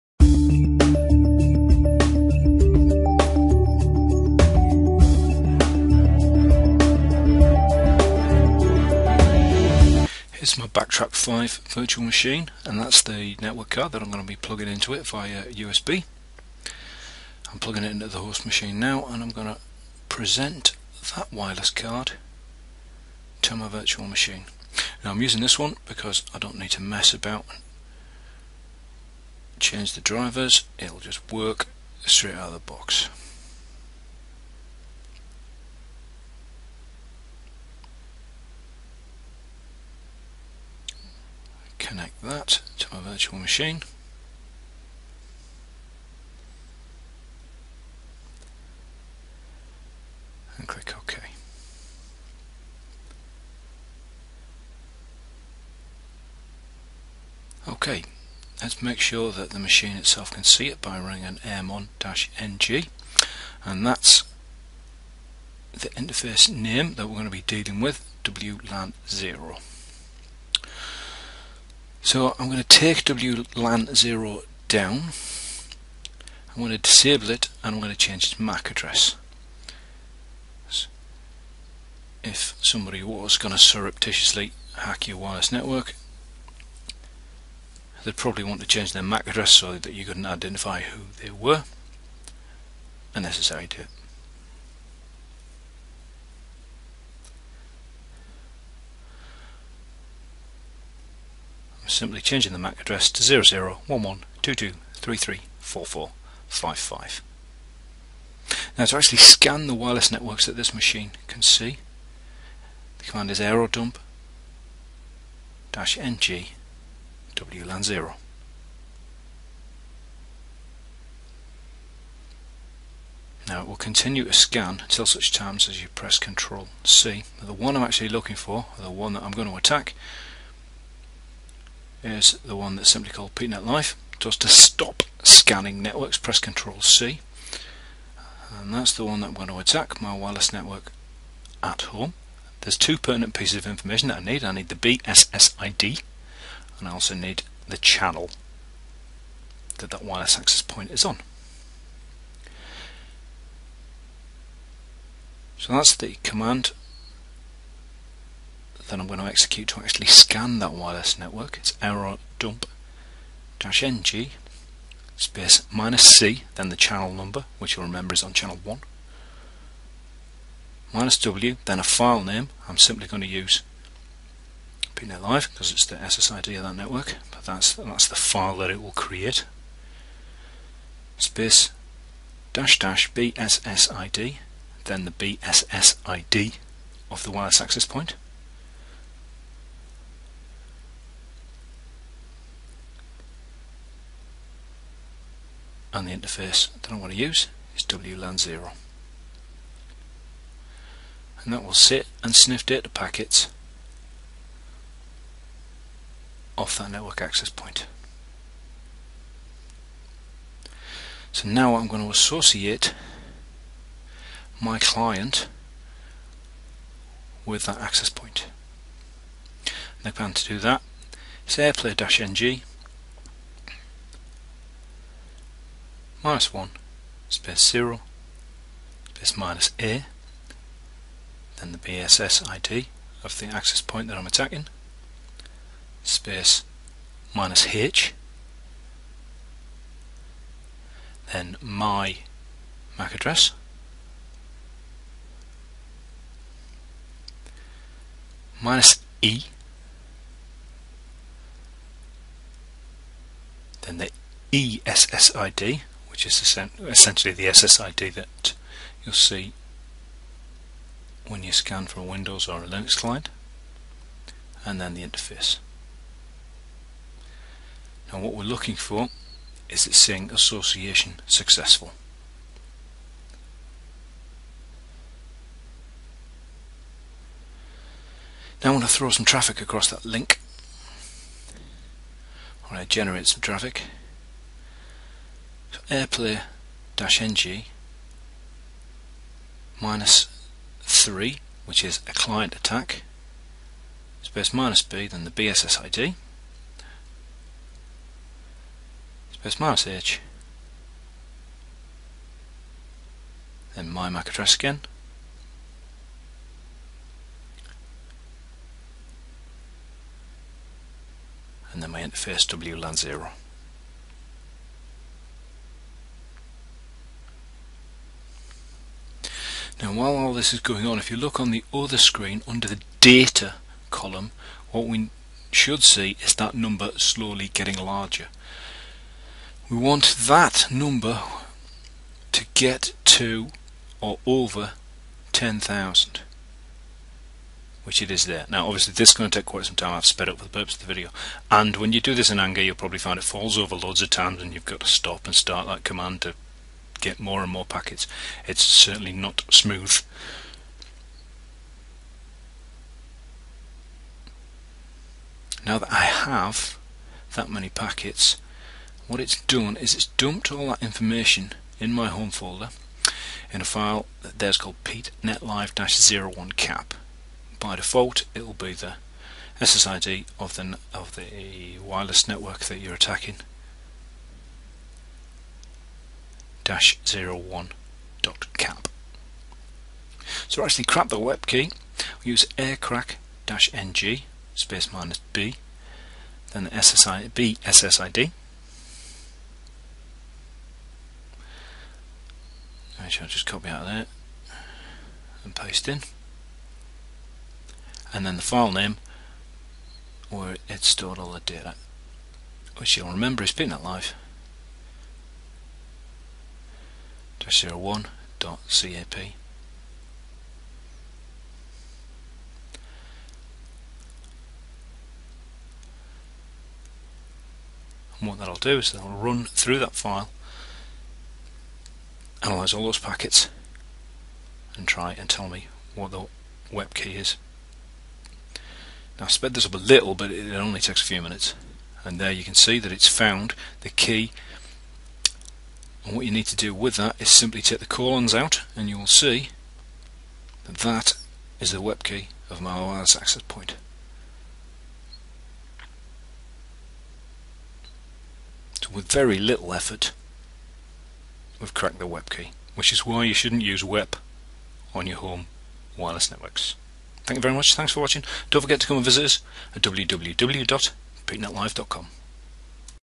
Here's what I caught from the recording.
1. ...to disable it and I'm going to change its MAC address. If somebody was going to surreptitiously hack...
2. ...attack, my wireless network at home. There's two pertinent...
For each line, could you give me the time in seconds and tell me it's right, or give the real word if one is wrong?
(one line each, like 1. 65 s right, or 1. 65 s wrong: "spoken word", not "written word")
1. 76 s right
2. 139 s right.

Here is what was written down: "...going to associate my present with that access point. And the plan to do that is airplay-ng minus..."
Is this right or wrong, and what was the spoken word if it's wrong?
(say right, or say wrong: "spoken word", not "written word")
wrong: "client", not "present".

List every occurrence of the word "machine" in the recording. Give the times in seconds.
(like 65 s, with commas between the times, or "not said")
12 s, 18 s, 24 s, 43 s, 59 s, 110 s.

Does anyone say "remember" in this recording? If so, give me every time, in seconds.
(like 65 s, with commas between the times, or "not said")
167 s, 403 s.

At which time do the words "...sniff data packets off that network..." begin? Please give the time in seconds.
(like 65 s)
202 s.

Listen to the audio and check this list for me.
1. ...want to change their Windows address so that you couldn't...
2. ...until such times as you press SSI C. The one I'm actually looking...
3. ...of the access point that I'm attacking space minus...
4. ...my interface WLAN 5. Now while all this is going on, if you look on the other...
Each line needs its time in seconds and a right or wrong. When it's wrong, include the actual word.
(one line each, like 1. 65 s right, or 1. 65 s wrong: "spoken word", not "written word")
1. 88 s wrong: "MAC", not "Windows"
2. 124 s wrong: "Ctrl", not "SSI"
3. 233 s right
4. 311 s wrong: "0", not "5".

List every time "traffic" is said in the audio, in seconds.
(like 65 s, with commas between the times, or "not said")
279 s, 283 s.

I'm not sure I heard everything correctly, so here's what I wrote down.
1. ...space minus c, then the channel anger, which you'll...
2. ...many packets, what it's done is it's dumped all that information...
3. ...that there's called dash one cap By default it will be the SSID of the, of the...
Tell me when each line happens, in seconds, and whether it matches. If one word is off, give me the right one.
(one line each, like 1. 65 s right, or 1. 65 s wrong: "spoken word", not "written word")
1. 165 s wrong: "number", not "anger"
2. 357 s right
3. 364 s right.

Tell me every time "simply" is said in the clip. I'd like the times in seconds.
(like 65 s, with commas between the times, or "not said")
101 s, 132 s, 172 s, 437 s.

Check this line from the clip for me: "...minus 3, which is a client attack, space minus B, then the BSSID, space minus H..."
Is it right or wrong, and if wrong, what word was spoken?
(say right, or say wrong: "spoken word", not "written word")
right.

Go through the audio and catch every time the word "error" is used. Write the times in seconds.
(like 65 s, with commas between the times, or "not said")
161 s.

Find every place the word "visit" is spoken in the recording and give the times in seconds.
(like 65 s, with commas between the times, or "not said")
459 s.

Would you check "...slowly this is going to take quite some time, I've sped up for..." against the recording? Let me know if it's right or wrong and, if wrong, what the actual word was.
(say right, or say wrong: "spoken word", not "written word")
wrong: "obviously", not "slowly".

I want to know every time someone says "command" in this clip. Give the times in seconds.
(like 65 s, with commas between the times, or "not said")
113 s, 156 s, 345 s.